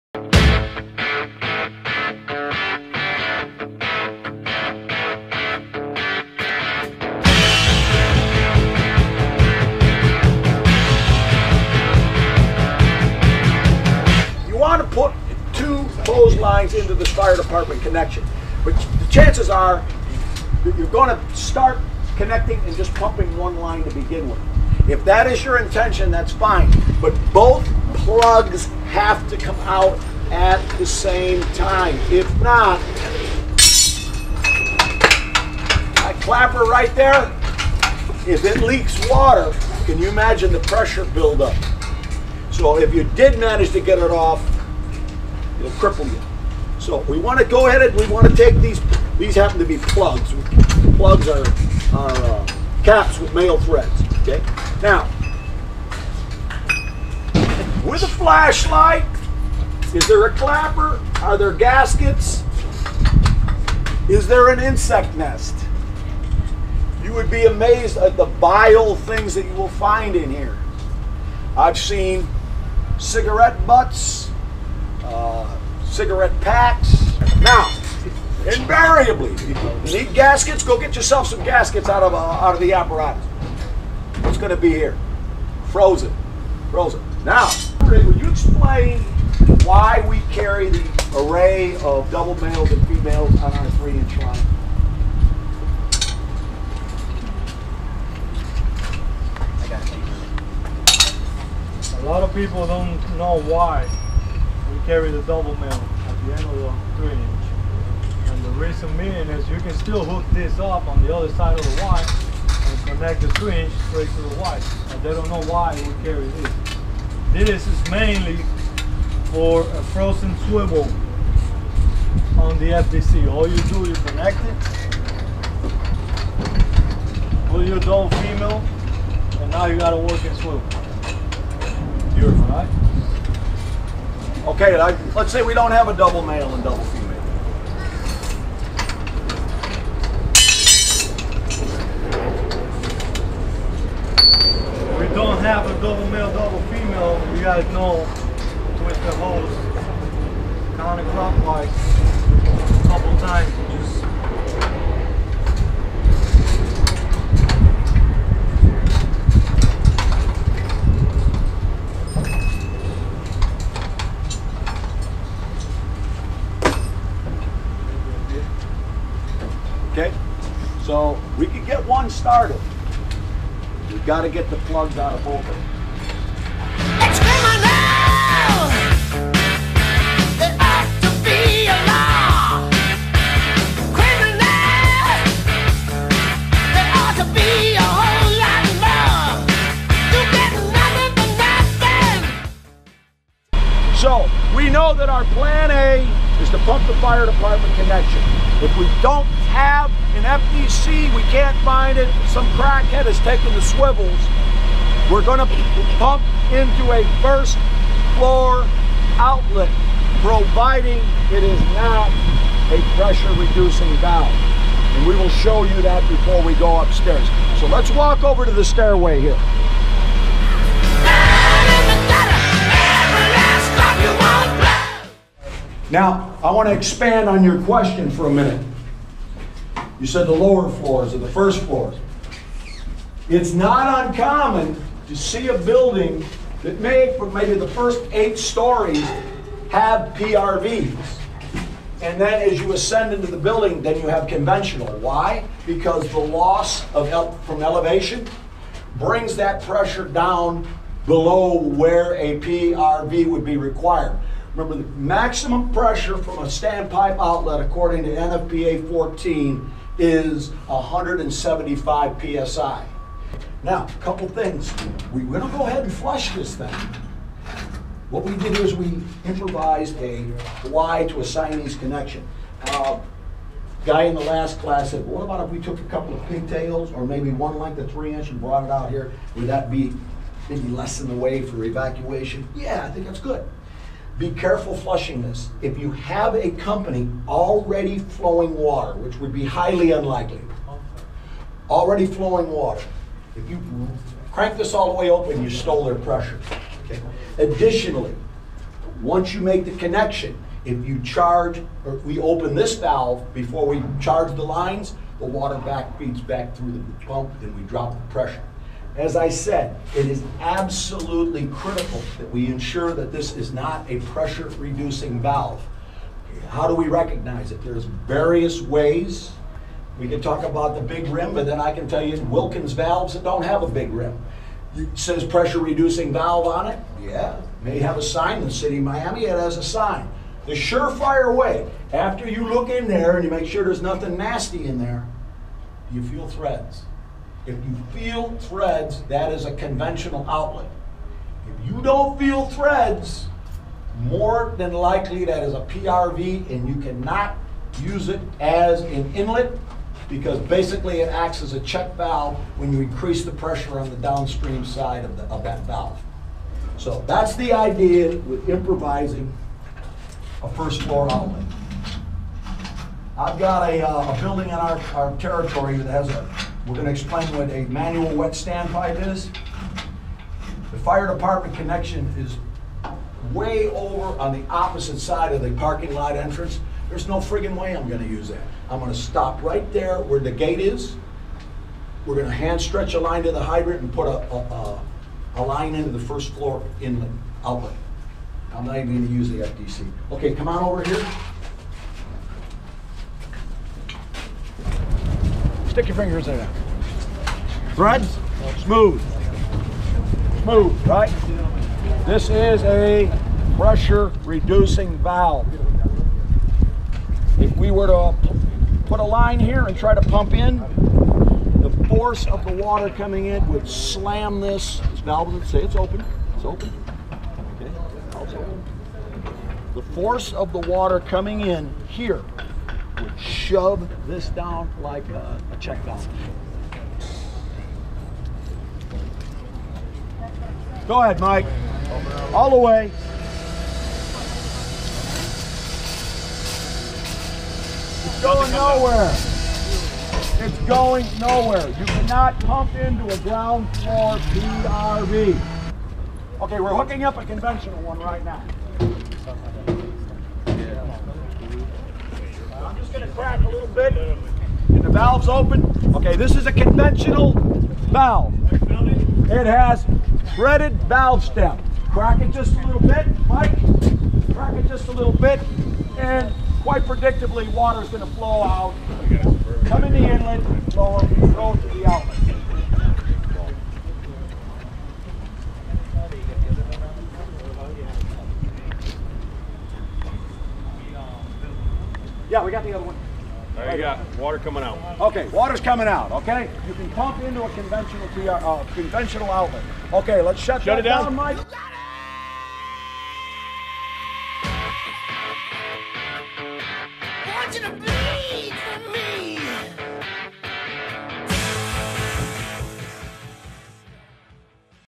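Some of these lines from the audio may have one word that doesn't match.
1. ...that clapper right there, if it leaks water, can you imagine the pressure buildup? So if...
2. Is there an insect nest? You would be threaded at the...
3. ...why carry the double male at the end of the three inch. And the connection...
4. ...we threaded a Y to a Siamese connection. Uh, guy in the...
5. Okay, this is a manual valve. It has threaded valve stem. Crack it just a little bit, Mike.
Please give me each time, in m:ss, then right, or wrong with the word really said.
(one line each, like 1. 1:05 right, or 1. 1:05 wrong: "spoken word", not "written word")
1. 0:35 right
2. 1:04 wrong: "amazed", not "threaded"
3. 1:43 wrong: "reason", not "connection"
4. 4:28 wrong: "improvised", not "threaded"
5. 7:35 wrong: "conventional", not "manual".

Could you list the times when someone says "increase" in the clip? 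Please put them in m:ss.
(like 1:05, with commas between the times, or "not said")
5:52.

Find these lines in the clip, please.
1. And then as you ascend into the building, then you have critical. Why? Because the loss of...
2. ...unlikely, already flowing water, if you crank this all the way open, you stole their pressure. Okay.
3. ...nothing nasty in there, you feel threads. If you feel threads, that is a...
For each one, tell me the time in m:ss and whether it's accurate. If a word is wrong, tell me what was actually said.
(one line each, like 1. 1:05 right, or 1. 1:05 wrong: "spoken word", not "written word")
1. 4:02 wrong: "conventional", not "critical"
2. 4:49 right
3. 5:33 right.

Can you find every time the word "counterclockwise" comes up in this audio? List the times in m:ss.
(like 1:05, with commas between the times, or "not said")
2:30.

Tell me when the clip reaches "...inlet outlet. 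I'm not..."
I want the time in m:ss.
6:26.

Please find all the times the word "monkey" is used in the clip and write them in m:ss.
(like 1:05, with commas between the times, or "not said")
not said.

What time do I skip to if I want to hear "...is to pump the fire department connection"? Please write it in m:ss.
3:16.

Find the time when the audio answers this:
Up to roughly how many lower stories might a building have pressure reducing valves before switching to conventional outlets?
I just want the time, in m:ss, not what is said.
3:58.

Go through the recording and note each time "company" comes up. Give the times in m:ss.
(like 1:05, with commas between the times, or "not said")
4:46.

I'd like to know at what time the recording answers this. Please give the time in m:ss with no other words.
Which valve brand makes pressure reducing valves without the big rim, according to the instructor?
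5:22.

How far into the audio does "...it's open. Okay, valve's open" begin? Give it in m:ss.
6:56.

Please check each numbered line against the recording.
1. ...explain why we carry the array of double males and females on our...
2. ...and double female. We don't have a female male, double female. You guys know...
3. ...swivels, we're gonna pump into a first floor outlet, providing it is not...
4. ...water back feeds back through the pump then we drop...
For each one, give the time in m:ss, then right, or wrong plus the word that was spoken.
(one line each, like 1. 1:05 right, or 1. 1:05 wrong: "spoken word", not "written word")
1. 1:28 right
2. 2:16 wrong: "double", not "female"
3. 3:23 right
4. 5:05 right.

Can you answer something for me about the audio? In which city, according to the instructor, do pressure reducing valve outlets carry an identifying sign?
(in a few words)
Miami.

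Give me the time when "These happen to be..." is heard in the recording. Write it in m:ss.
0:49.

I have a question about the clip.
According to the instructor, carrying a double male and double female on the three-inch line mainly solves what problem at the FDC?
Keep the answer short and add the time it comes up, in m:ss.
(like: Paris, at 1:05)
A frozen swivel, at 1:59.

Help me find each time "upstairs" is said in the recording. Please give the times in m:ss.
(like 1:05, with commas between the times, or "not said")
3:36.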